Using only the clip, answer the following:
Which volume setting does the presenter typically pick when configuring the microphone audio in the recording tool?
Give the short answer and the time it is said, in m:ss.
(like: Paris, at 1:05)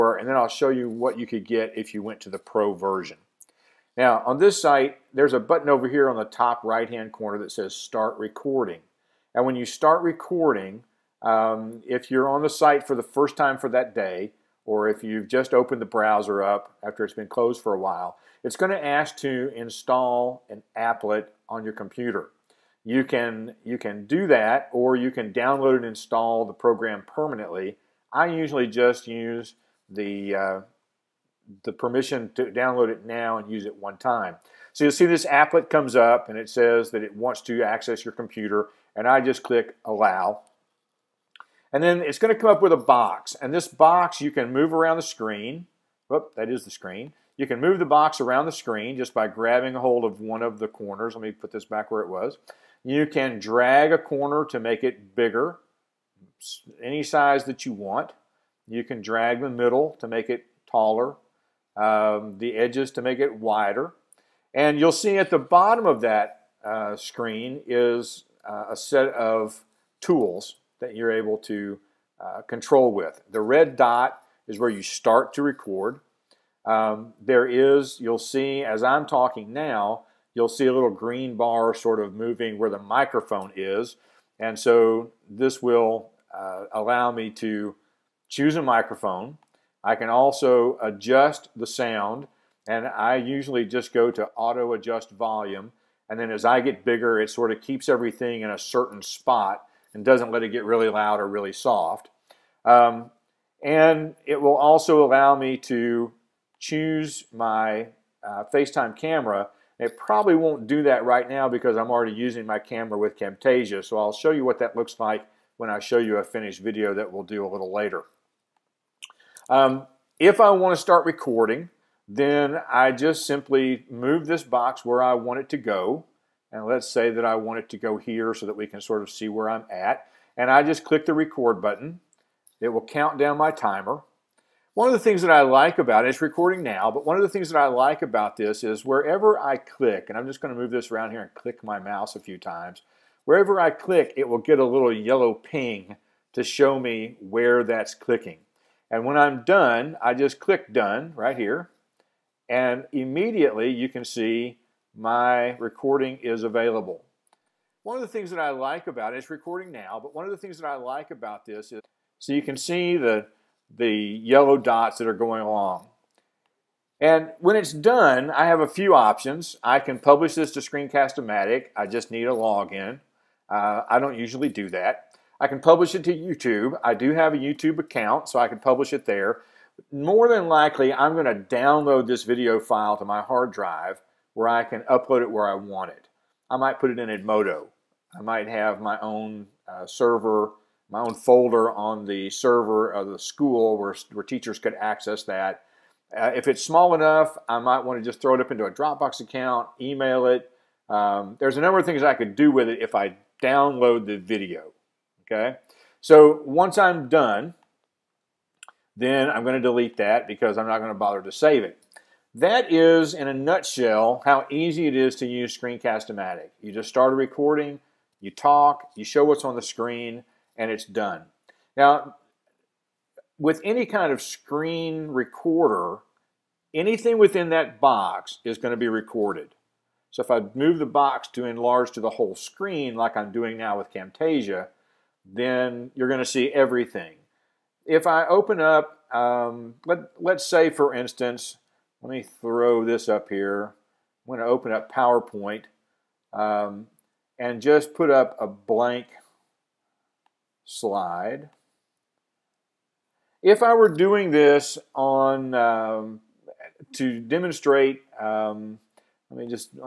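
auto adjust volume, at 1:34.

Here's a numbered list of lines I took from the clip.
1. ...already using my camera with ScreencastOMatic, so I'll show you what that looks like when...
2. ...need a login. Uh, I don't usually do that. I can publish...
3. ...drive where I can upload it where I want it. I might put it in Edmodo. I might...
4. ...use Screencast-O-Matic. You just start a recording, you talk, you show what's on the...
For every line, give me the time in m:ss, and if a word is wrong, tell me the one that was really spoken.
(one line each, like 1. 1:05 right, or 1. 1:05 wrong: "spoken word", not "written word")
1. 1:51 wrong: "Camtasia", not "ScreencastOMatic"
2. 2:52 right
3. 3:03 right
4. 3:35 right.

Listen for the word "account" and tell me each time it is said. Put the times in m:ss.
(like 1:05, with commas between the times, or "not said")
2:57, 3:19.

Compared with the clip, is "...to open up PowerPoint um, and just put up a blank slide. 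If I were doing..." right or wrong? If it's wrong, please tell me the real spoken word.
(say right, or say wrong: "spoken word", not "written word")
right.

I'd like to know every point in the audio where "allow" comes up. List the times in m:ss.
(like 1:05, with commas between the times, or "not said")
0:39, 1:26, 1:45.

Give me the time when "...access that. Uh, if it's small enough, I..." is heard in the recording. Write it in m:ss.
3:14.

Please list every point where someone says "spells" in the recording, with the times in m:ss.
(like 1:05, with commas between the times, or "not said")
not said.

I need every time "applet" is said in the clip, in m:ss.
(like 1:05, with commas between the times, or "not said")
0:20, 0:35.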